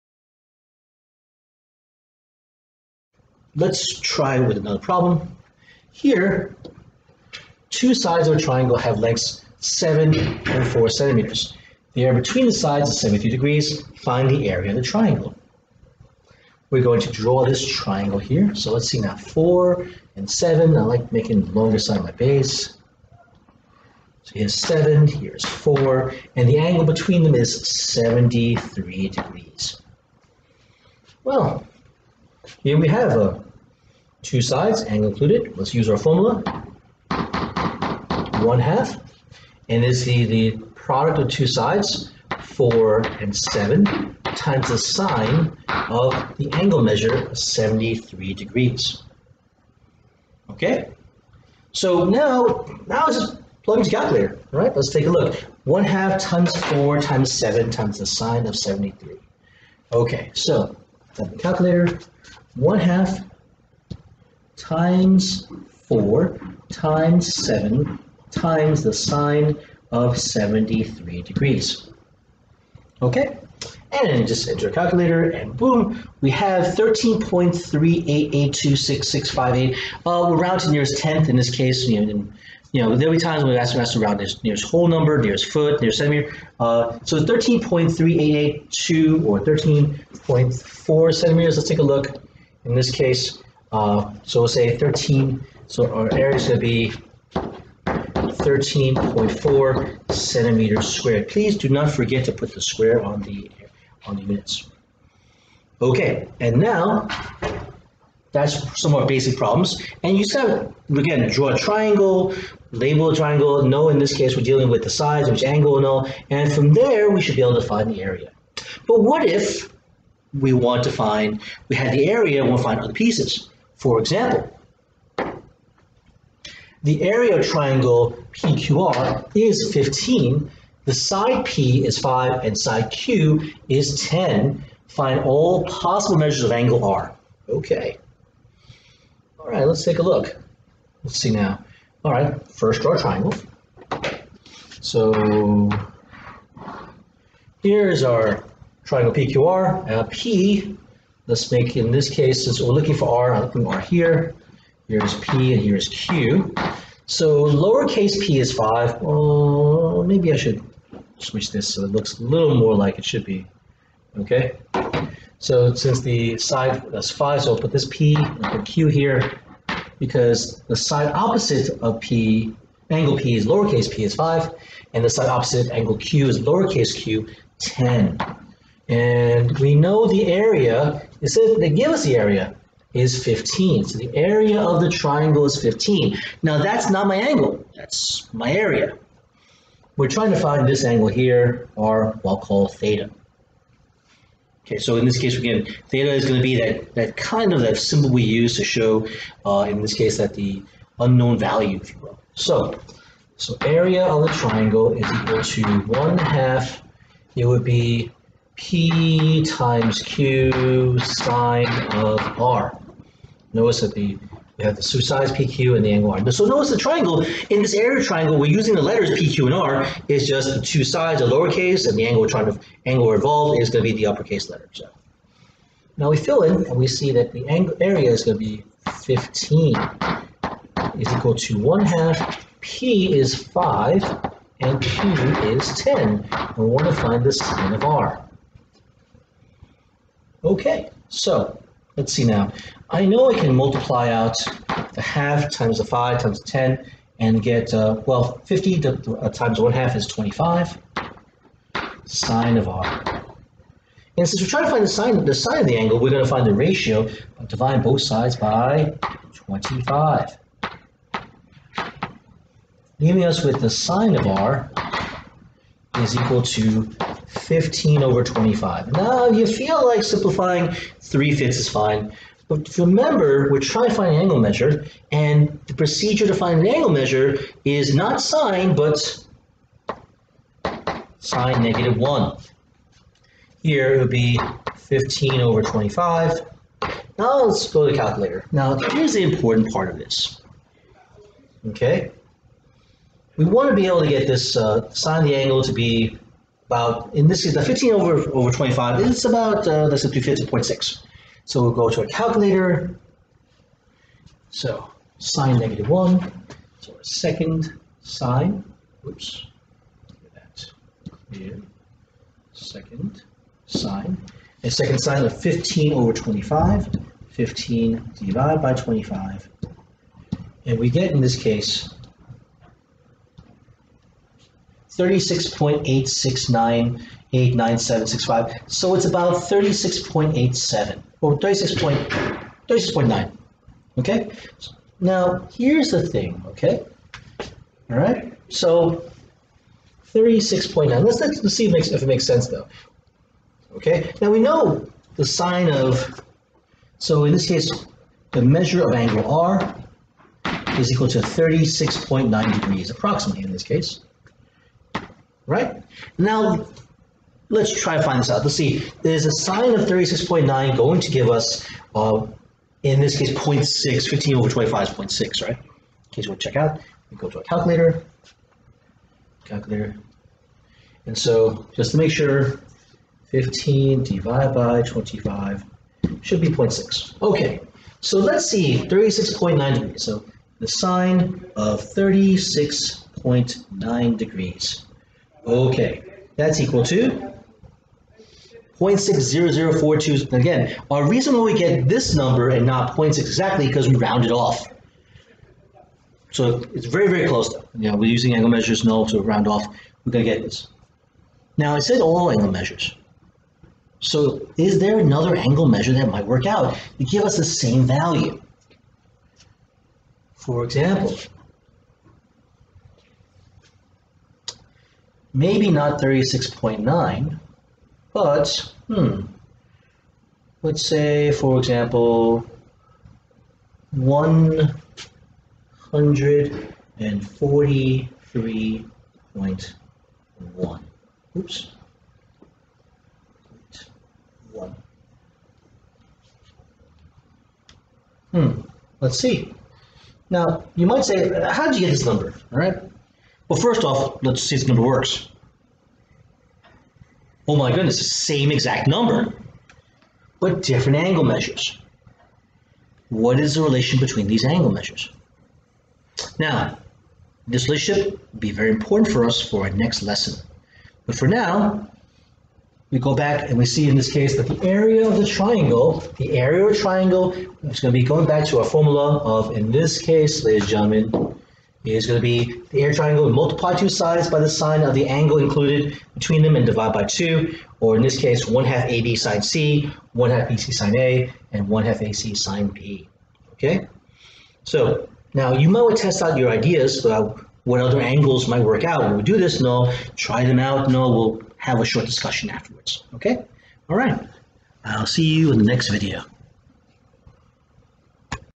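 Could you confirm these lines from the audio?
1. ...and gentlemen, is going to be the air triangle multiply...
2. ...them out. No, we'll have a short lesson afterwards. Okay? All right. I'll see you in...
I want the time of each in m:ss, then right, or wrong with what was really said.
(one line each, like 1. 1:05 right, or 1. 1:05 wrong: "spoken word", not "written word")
1. 7:50 right
2. 8:10 wrong: "discussion", not "lesson".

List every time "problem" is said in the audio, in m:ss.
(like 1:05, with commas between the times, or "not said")
0:04, 1:49.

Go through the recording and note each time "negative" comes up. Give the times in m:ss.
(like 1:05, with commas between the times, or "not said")
4:41, 5:05.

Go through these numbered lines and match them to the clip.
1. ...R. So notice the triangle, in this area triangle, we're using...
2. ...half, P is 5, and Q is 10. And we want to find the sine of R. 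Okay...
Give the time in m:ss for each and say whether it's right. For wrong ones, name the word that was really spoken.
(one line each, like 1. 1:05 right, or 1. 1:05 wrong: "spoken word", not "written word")
1. 3:36 right
2. 3:51 right.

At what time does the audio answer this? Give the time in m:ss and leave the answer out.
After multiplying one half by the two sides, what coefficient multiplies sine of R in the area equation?
4:10.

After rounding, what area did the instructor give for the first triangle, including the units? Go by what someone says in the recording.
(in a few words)
13.4 square centimeters.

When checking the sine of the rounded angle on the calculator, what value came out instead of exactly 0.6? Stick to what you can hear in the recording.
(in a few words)
0.60042.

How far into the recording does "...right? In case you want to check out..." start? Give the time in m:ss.
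6:05.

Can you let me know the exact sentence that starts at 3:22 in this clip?
So, so area of the triangle is equal to 1 half, it would be P times Q sine of R.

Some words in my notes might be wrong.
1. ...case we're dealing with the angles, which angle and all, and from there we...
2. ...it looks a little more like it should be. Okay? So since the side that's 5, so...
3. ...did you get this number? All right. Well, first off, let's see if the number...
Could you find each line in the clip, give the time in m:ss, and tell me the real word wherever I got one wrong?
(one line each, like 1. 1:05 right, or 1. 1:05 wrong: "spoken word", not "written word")
1. 1:54 wrong: "sides", not "angles"
2. 2:41 right
3. 7:21 right.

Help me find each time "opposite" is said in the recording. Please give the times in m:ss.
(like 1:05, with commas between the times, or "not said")
2:51, 2:55.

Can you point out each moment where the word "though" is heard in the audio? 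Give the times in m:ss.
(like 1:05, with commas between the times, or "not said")
5:42, 6:37.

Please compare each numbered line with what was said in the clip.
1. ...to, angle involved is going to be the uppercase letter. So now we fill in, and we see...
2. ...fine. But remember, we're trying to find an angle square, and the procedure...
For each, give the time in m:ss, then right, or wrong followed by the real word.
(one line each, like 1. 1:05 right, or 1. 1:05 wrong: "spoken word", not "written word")
1. 3:42 right
2. 4:31 wrong: "measure", not "square".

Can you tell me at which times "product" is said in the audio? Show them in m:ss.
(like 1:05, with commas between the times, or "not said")
0:40.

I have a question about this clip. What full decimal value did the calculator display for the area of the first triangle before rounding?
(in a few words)
13.3882658.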